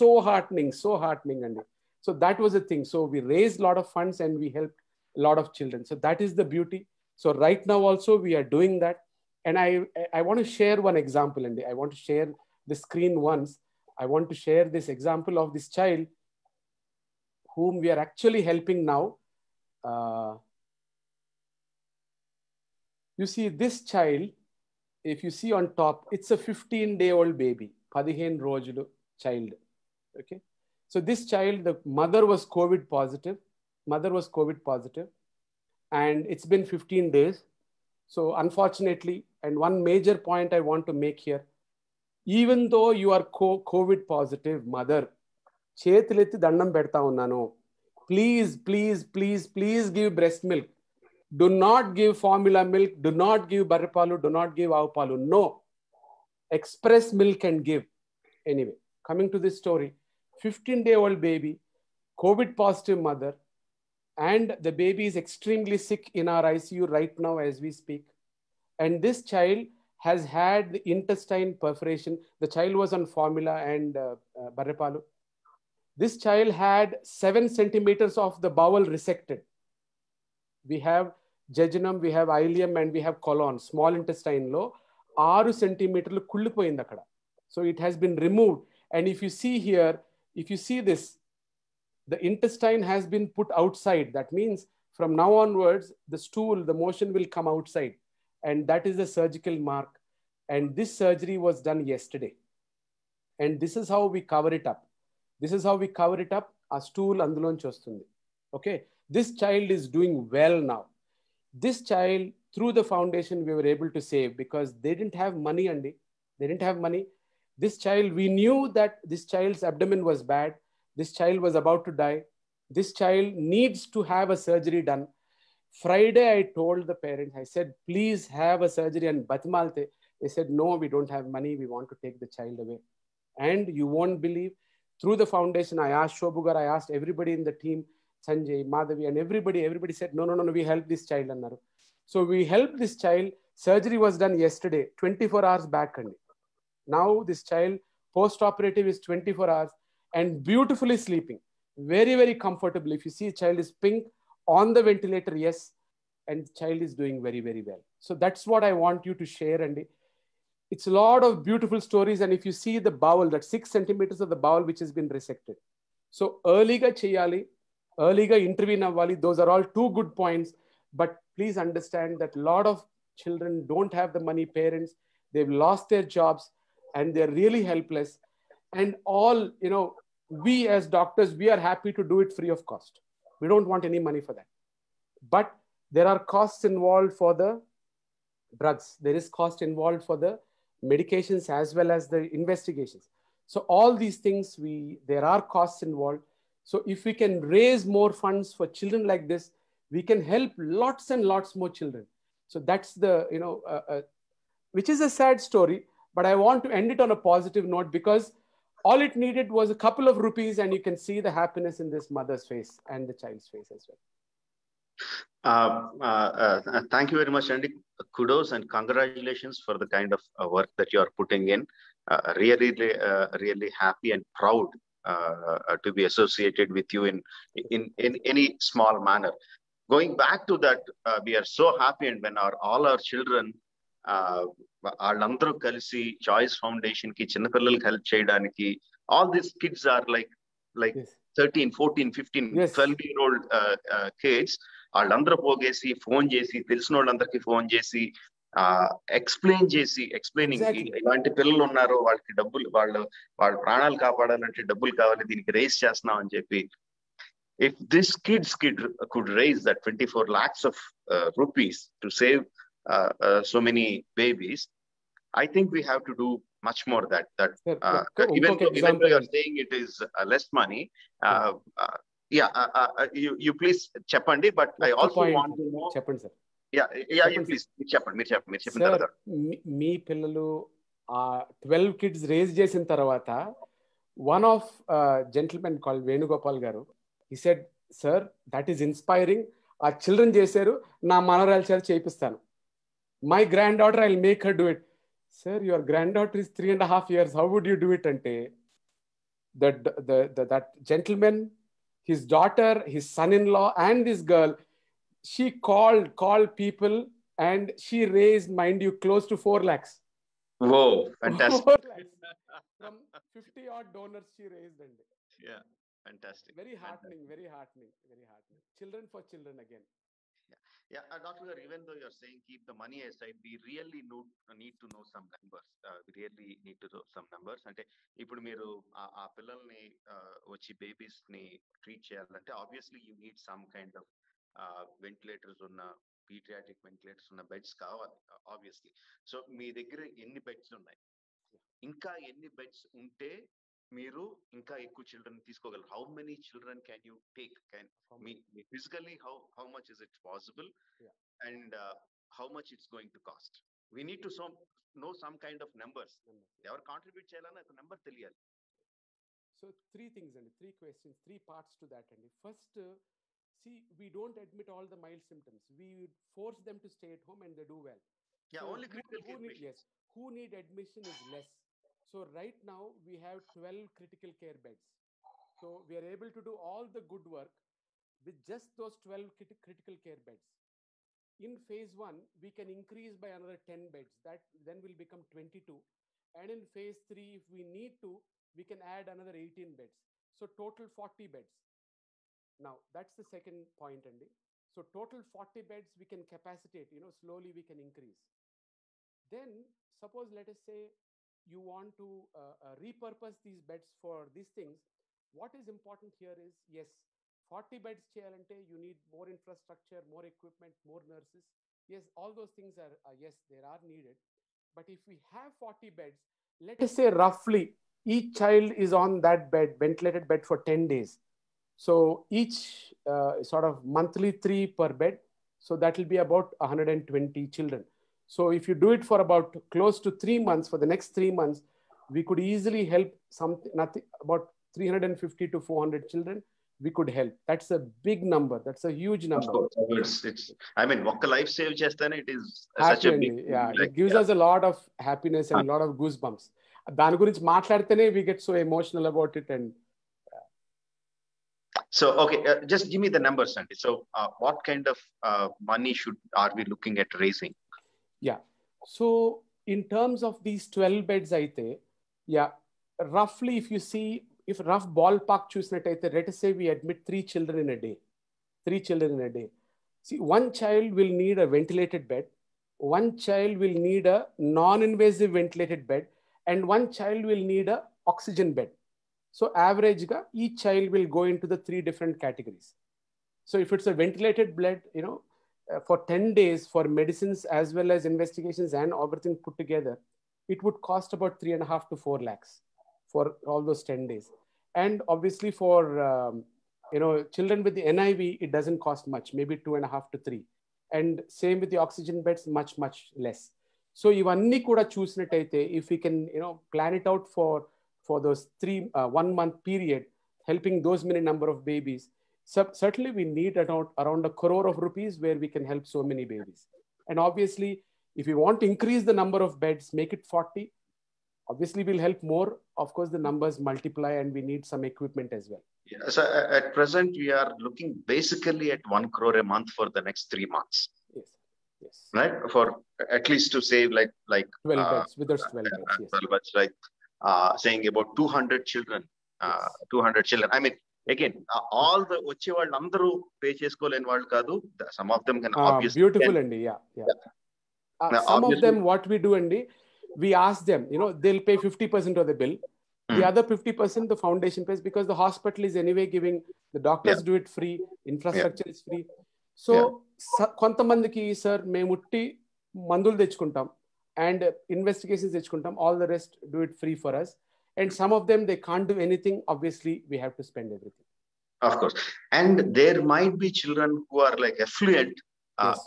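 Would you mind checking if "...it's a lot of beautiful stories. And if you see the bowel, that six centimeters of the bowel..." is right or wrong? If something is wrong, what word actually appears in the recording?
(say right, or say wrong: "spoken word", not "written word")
right.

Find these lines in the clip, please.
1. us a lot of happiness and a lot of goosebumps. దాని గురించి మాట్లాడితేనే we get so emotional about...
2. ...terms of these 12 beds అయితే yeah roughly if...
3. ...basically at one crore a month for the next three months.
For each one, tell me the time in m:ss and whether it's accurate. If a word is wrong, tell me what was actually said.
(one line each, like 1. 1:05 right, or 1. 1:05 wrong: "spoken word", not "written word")
1. 7:24 right
2. 7:39 right
3. 8:48 right.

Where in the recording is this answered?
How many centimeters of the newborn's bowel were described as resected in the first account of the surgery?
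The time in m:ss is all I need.
1:17.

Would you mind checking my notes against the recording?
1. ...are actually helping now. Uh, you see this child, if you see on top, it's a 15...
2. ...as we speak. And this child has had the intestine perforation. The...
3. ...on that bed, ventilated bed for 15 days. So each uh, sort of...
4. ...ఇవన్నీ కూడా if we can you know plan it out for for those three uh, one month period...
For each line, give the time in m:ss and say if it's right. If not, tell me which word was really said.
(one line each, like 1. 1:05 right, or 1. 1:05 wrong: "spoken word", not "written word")
1. 0:17 right
2. 1:07 right
3. 6:58 wrong: "10", not "15"
4. 8:24 right.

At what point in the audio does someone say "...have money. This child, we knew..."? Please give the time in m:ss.
1:56.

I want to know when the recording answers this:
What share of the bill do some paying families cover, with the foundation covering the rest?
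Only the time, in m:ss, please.
9:11.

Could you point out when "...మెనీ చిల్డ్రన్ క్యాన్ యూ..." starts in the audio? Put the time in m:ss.
5:46.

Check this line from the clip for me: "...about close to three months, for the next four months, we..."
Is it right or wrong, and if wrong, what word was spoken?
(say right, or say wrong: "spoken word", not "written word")
wrong: "three", not "four".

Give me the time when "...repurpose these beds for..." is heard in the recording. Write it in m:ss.
6:42.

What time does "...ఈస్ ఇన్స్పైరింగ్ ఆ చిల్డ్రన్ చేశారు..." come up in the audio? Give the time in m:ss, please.
4:48.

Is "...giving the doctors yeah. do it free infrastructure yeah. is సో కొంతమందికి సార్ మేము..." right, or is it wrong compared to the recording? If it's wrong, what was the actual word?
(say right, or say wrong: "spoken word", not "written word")
right.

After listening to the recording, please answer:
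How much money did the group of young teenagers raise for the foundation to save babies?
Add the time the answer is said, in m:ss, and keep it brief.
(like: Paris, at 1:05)
24 lakhs, at 4:19.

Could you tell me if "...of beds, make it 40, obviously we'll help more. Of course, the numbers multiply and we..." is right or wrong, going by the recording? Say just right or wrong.
right.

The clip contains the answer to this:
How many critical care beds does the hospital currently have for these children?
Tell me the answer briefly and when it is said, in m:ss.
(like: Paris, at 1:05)
12, at 6:13.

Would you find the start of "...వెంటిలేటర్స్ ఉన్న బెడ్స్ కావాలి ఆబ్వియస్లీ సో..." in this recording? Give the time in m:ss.
5:36.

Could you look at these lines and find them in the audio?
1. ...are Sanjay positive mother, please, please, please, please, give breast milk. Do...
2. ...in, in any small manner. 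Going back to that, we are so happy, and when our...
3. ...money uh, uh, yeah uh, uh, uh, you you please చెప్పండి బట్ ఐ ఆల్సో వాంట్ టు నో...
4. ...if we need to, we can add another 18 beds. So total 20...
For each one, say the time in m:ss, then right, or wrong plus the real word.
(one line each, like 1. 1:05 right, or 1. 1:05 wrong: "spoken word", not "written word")
1. 0:43 wrong: "COVID", not "Sanjay"
2. 3:47 right
3. 4:30 right
4. 6:27 wrong: "40", not "20".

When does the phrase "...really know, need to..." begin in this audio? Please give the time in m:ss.
5:23.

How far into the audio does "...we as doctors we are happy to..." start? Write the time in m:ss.
3:00.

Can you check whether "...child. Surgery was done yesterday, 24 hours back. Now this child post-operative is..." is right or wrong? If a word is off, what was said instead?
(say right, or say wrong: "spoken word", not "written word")
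right.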